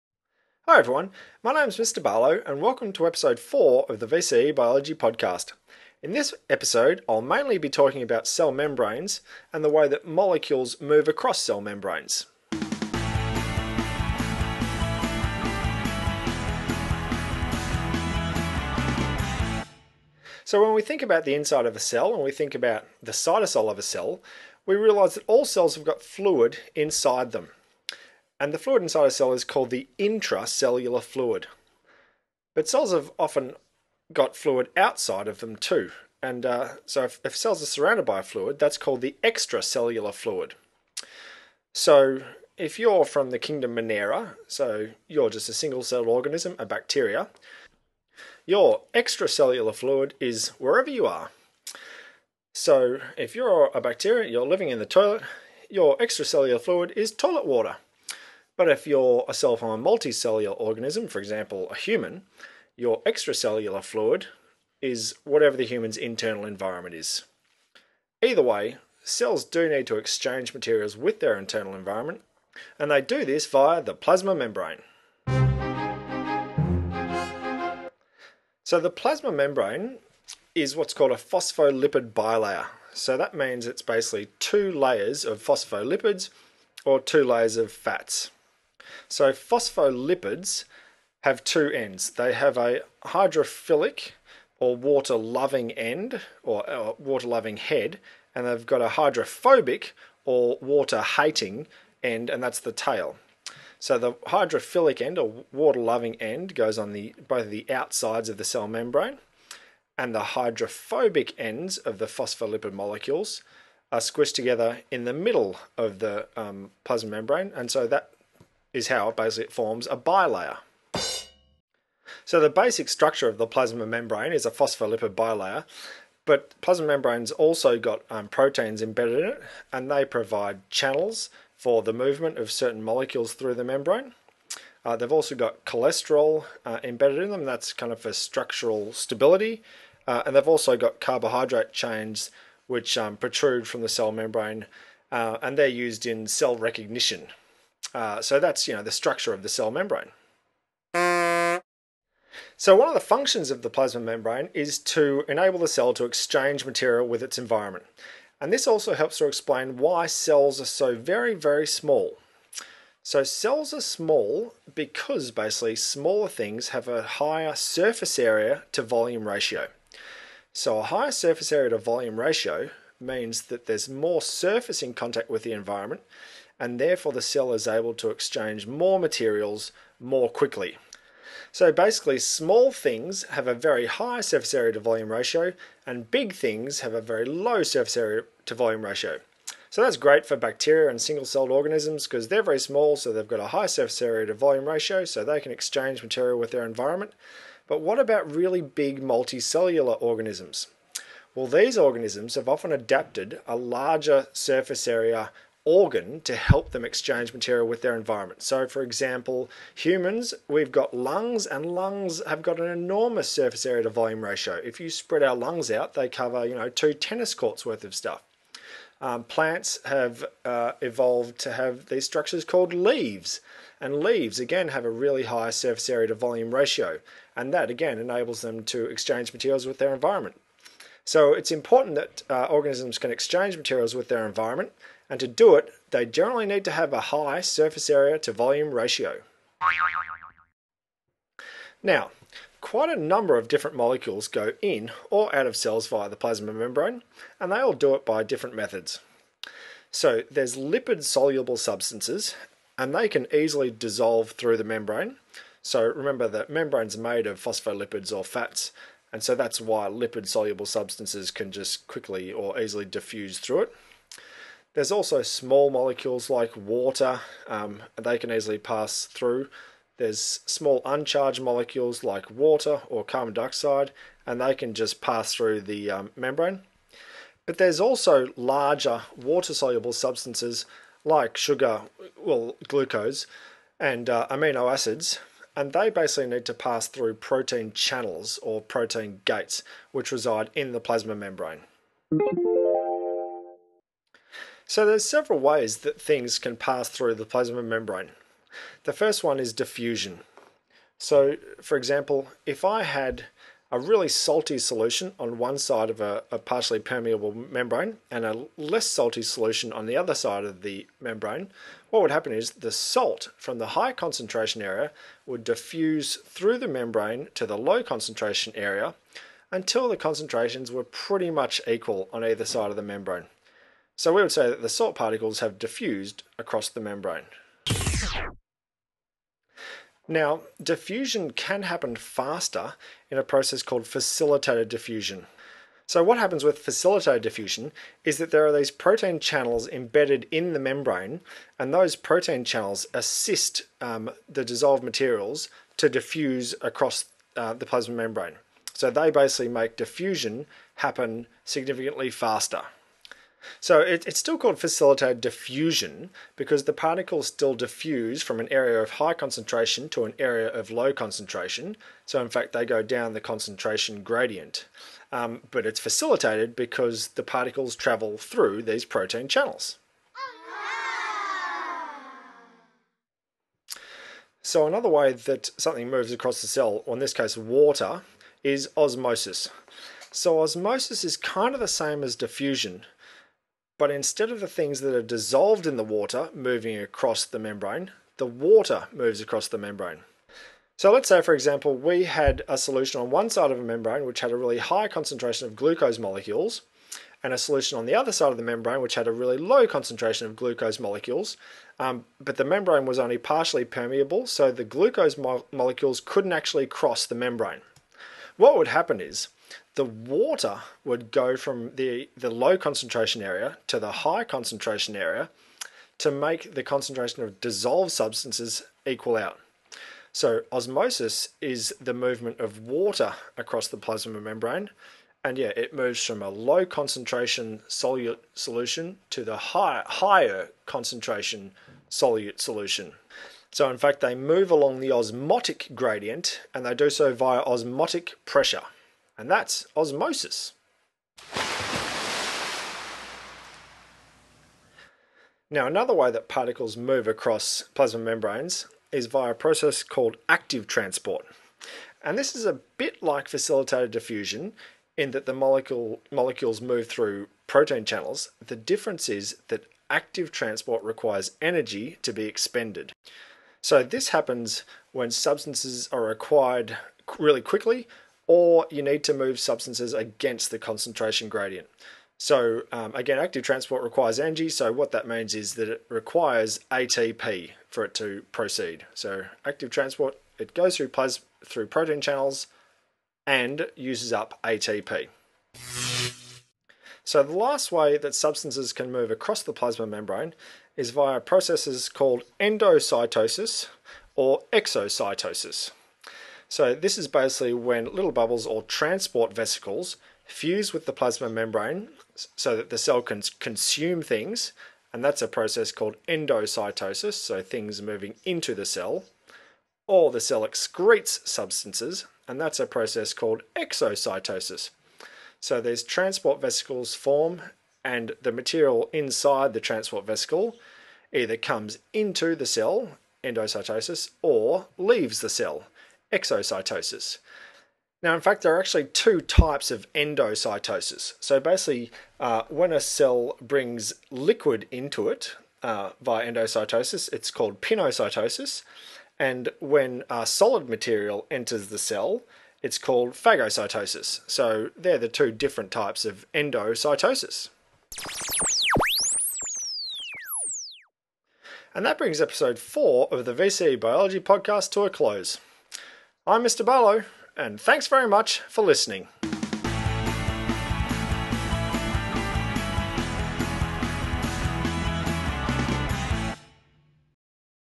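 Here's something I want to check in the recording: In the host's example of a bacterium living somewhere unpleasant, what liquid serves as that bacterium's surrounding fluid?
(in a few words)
Toilet water.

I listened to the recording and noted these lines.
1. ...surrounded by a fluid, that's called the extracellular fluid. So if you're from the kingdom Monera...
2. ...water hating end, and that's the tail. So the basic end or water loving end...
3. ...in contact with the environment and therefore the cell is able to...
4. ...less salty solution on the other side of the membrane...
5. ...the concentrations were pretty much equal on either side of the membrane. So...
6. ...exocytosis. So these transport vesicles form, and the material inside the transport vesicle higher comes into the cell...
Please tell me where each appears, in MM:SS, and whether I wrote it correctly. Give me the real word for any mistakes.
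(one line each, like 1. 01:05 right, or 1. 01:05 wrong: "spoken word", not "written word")
1. 00:37 right
2. 01:40 wrong: "hydrophilic", not "basic"
3. 02:54 right
4. 05:08 right
5. 05:19 right
6. 08:33 wrong: "either", not "higher".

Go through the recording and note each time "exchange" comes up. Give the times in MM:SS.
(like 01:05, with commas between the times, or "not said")
01:09, 02:36, 02:58, 03:15, 03:26, 03:48, 03:53.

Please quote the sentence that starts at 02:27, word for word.
Uh, so that's you know the structure of the cell membrane.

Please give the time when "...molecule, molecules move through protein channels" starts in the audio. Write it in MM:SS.
07:35.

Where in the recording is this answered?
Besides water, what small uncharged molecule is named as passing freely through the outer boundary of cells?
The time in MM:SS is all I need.
04:33.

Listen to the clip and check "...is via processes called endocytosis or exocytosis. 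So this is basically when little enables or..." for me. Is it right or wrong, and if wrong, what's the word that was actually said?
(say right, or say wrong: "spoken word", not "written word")
wrong: "bubbles", not "enables".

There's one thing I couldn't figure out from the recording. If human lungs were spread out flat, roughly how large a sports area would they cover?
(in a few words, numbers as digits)
2 tennis courts.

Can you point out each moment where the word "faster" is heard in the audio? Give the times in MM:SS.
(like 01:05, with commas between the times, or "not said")
05:31, 05:52.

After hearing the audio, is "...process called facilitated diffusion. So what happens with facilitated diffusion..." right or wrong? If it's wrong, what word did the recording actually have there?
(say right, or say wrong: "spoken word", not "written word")
right.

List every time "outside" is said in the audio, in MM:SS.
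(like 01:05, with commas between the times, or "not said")
00:34, 01:47.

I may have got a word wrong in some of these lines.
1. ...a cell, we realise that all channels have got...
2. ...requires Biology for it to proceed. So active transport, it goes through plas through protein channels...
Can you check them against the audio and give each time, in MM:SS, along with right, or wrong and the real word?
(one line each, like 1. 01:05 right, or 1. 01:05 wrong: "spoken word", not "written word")
1. 00:23 wrong: "cells", not "channels"
2. 07:55 wrong: "ATP", not "Biology".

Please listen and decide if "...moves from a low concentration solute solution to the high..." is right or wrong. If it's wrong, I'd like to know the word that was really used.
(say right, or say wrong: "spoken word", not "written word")
right.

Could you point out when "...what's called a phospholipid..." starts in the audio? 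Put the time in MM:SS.
01:20.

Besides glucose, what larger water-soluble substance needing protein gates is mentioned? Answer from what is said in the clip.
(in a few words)
Amino acids.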